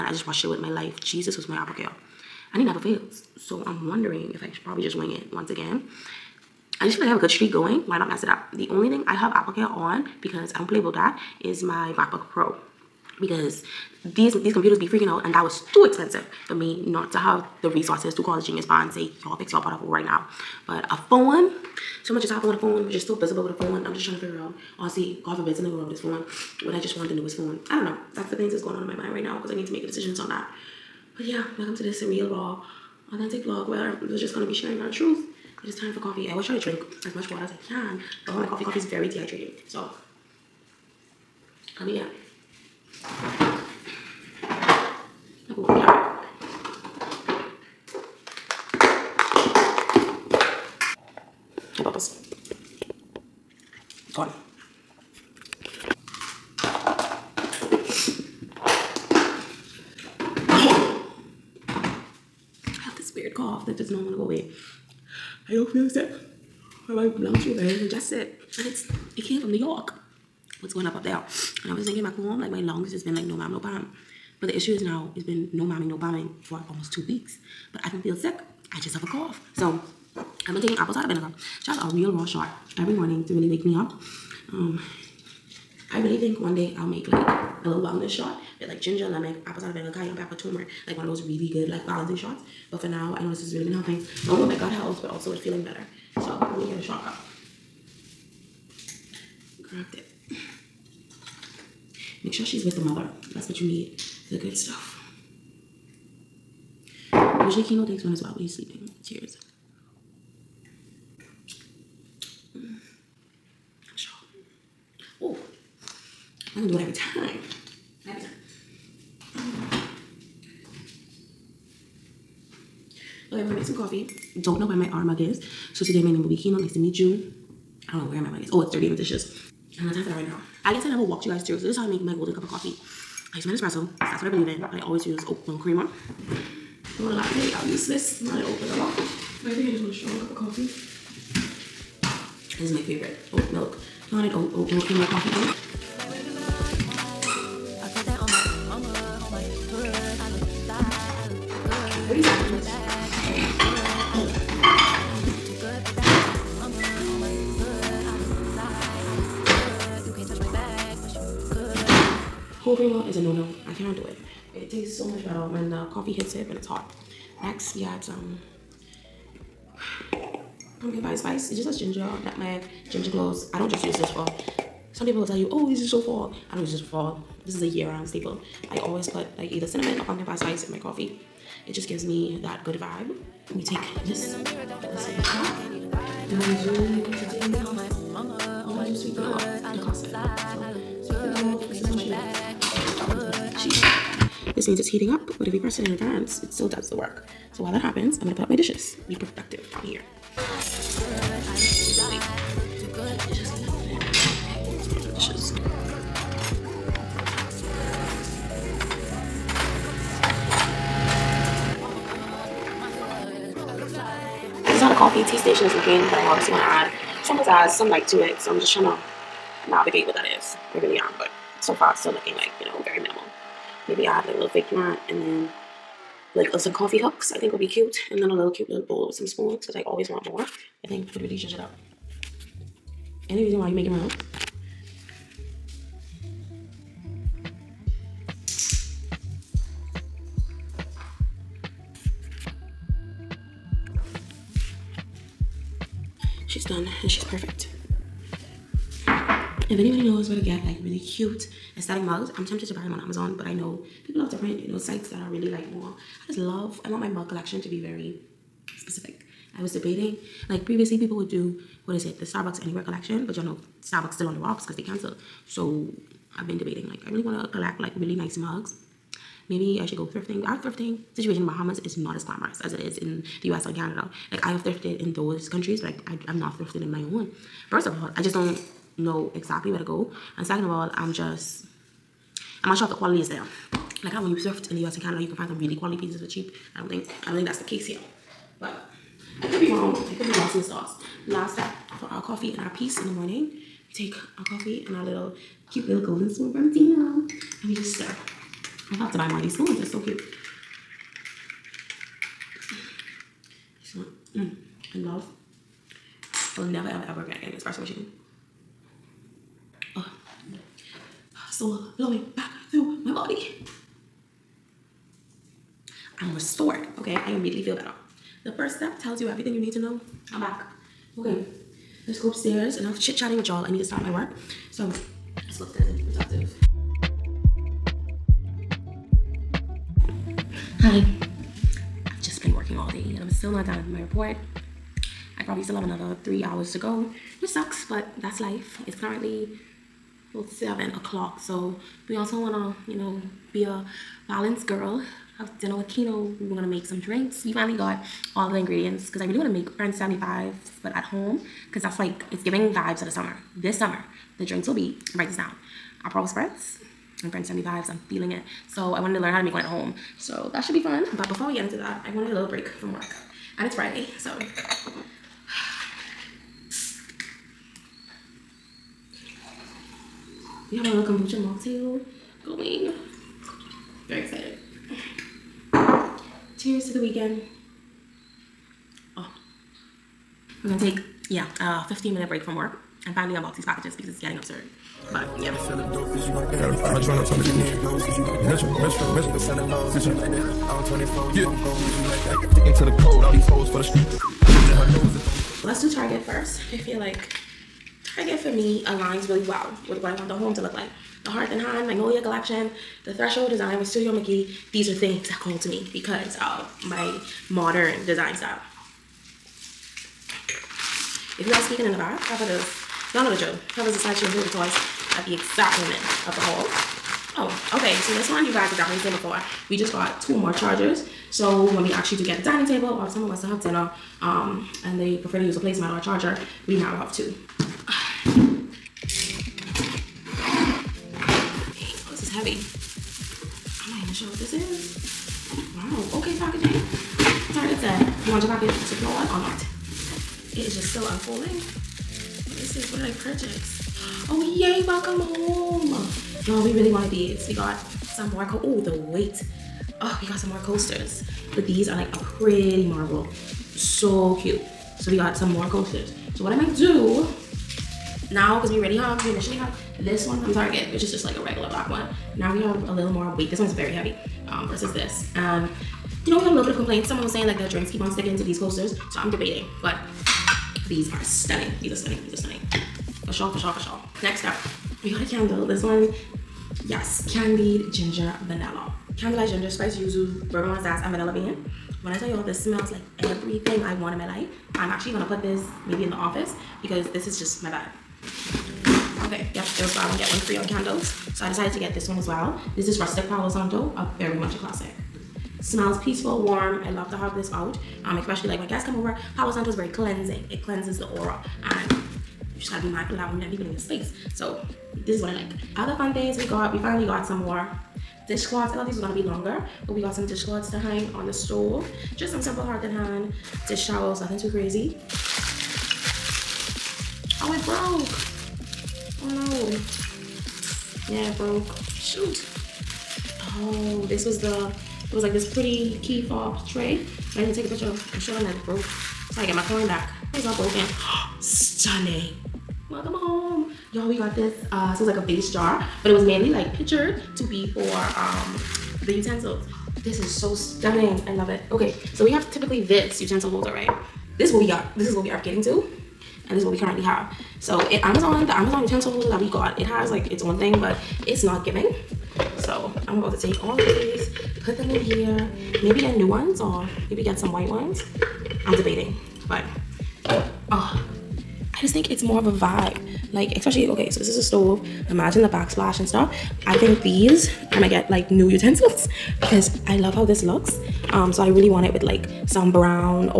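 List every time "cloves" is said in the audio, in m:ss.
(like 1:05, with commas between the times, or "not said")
2:53.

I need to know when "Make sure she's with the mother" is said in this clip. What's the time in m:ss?
1:42.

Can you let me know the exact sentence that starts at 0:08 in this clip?
The only thing I have AppleCare on because I don't play with that is my MacBook Pro.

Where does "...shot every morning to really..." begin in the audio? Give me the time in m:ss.
1:22.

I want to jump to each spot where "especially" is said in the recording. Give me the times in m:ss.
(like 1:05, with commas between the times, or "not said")
8:18, 9:23.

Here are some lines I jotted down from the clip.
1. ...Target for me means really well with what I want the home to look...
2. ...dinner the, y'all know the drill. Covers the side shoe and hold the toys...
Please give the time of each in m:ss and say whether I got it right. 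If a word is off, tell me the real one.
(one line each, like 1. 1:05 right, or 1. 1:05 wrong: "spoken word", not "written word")
1. 6:38 wrong: "aligns", not "means"
2. 6:52 wrong: "cover", not "dinner".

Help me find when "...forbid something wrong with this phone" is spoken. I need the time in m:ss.
0:25.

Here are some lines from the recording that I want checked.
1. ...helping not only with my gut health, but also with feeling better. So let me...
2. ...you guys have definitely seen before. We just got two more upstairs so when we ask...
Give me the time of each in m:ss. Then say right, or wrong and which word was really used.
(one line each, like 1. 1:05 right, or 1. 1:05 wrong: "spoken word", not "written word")
1. 1:33 right
2. 6:58 wrong: "chargers", not "upstairs".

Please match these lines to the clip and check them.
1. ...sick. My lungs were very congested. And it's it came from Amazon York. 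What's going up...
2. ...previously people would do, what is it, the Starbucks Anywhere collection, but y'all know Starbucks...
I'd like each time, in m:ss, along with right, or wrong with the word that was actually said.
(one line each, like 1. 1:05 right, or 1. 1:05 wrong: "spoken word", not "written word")
1. 1:05 wrong: "New", not "Amazon"
2. 4:20 right.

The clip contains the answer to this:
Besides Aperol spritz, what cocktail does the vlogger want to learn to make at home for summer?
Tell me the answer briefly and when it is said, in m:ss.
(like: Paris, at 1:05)
French 75, at 5:49.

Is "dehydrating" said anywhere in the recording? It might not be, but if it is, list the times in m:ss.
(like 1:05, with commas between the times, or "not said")
0:39.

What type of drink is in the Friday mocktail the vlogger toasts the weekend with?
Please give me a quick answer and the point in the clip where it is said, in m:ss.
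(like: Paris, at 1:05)
kombucha, at 6:11.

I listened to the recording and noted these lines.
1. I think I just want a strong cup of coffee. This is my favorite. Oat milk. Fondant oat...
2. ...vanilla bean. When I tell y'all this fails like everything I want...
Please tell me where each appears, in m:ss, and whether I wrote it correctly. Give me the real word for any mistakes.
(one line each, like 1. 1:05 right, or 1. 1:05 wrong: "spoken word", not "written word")
1. 2:18 right
2. 8:01 wrong: "smells", not "fails".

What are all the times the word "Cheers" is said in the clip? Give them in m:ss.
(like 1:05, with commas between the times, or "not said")
1:49, 6:16.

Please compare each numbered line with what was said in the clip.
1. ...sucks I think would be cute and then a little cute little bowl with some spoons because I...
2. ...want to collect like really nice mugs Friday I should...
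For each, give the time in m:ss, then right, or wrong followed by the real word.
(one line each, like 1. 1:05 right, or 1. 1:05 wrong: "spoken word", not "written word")
1. 3:46 wrong: "hooks", not "sucks"
2. 4:27 wrong: "Maybe", not "Friday".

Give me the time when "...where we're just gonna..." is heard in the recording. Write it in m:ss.
0:33.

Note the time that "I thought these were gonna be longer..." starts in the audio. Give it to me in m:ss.
8:28.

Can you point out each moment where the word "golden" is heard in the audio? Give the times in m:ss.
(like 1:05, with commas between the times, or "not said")
2:12, 4:56.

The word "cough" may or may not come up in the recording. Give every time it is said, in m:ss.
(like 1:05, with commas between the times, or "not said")
1:03, 1:19.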